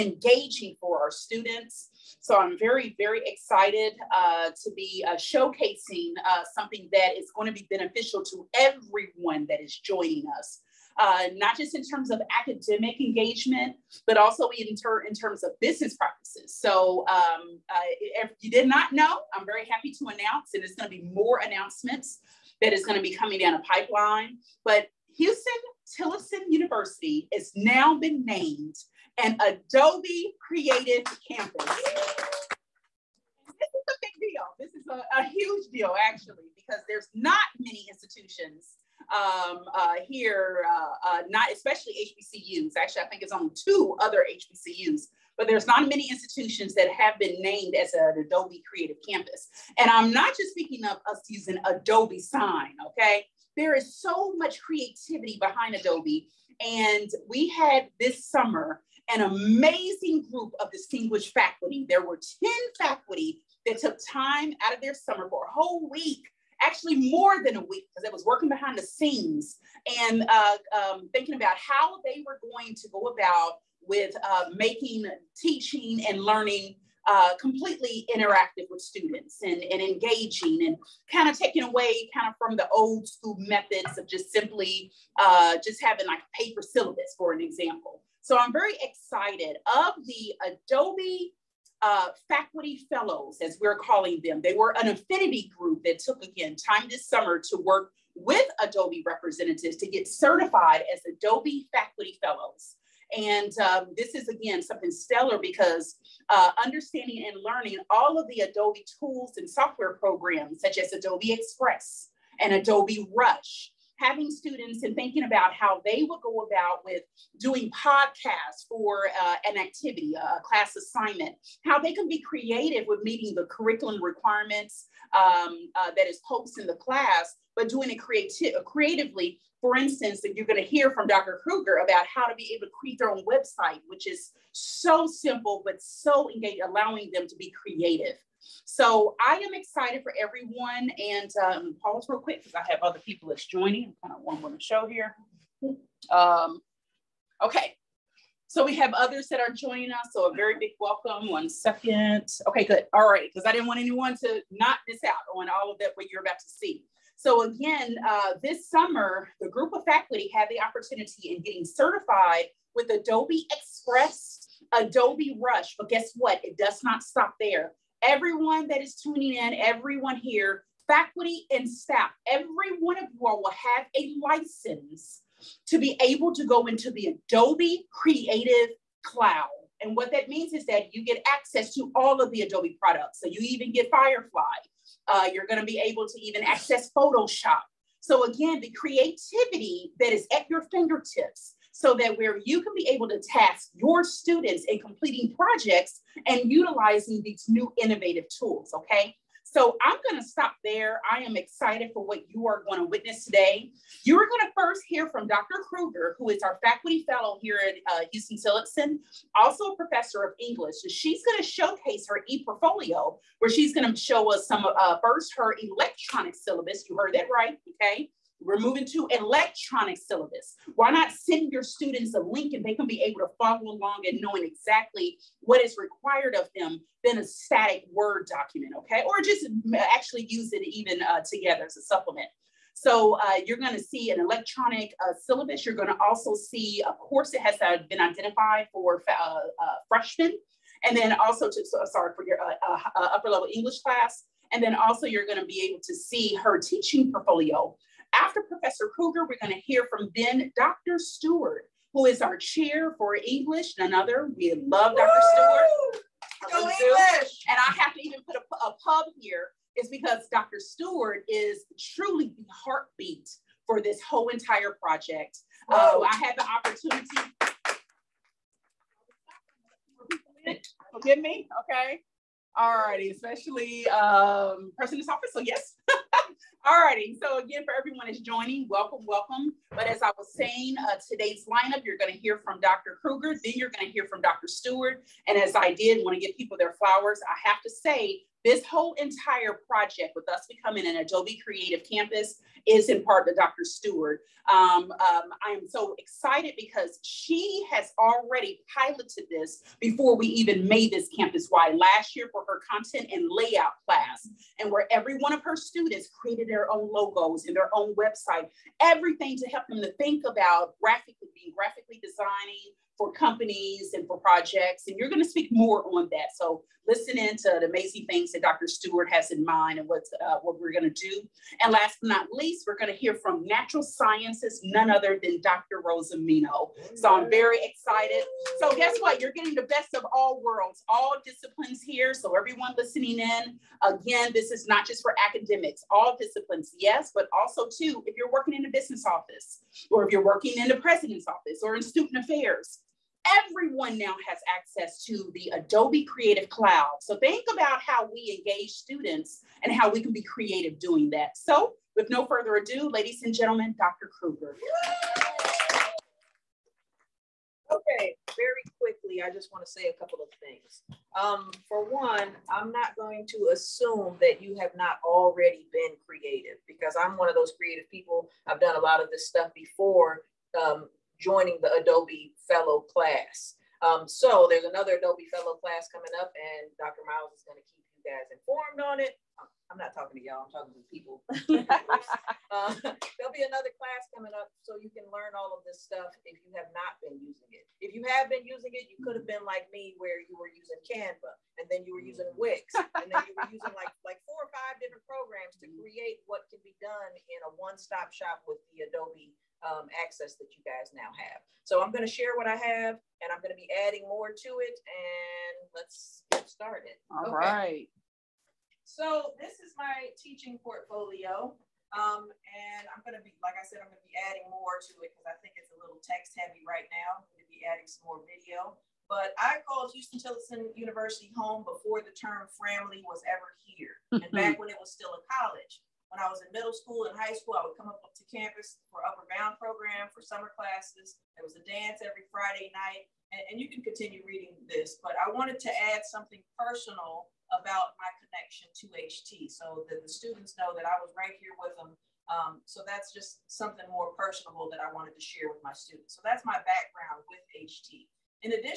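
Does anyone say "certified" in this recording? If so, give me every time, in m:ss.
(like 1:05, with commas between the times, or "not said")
1:40, 2:41.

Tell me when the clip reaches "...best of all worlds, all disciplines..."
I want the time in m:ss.
5:29.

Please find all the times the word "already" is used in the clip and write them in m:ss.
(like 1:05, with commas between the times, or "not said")
4:57, 6:05.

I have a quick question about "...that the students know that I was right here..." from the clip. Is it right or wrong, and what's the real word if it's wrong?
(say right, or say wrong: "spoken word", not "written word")
right.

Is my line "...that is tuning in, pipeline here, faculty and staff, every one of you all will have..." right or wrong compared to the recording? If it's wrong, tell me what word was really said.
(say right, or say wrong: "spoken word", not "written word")
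wrong: "everyone", not "pipeline".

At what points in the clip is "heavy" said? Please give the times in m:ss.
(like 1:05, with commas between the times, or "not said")
6:56.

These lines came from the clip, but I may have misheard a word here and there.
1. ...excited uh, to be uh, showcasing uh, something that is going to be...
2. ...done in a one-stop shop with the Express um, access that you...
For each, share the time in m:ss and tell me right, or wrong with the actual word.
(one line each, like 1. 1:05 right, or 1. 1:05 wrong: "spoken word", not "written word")
1. 0:03 right
2. 6:36 wrong: "Adobe", not "Express".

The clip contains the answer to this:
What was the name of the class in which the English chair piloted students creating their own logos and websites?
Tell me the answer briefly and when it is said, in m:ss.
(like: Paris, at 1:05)
content and layout, at 5:02.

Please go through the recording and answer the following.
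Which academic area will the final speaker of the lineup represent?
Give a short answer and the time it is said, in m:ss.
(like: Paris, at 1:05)
natural sciences, at 5:23.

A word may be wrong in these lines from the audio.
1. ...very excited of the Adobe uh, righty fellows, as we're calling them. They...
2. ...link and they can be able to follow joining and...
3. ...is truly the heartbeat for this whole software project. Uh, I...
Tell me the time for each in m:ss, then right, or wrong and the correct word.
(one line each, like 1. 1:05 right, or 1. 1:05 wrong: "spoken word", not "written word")
1. 1:28 wrong: "faculty", not "righty"
2. 3:42 wrong: "along", not "joining"
3. 4:21 wrong: "entire", not "software".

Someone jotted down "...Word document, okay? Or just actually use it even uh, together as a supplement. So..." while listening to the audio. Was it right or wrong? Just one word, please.
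right.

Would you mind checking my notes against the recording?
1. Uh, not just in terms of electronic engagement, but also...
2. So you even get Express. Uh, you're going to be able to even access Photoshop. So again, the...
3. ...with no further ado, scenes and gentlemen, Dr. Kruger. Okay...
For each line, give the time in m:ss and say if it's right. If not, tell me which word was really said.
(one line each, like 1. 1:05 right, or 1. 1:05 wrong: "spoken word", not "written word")
1. 0:10 wrong: "academic", not "electronic"
2. 3:03 wrong: "Firefly", not "Express"
3. 5:51 wrong: "ladies", not "scenes".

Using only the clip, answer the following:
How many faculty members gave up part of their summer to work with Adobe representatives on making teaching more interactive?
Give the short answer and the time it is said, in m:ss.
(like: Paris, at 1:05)
10, at 1:02.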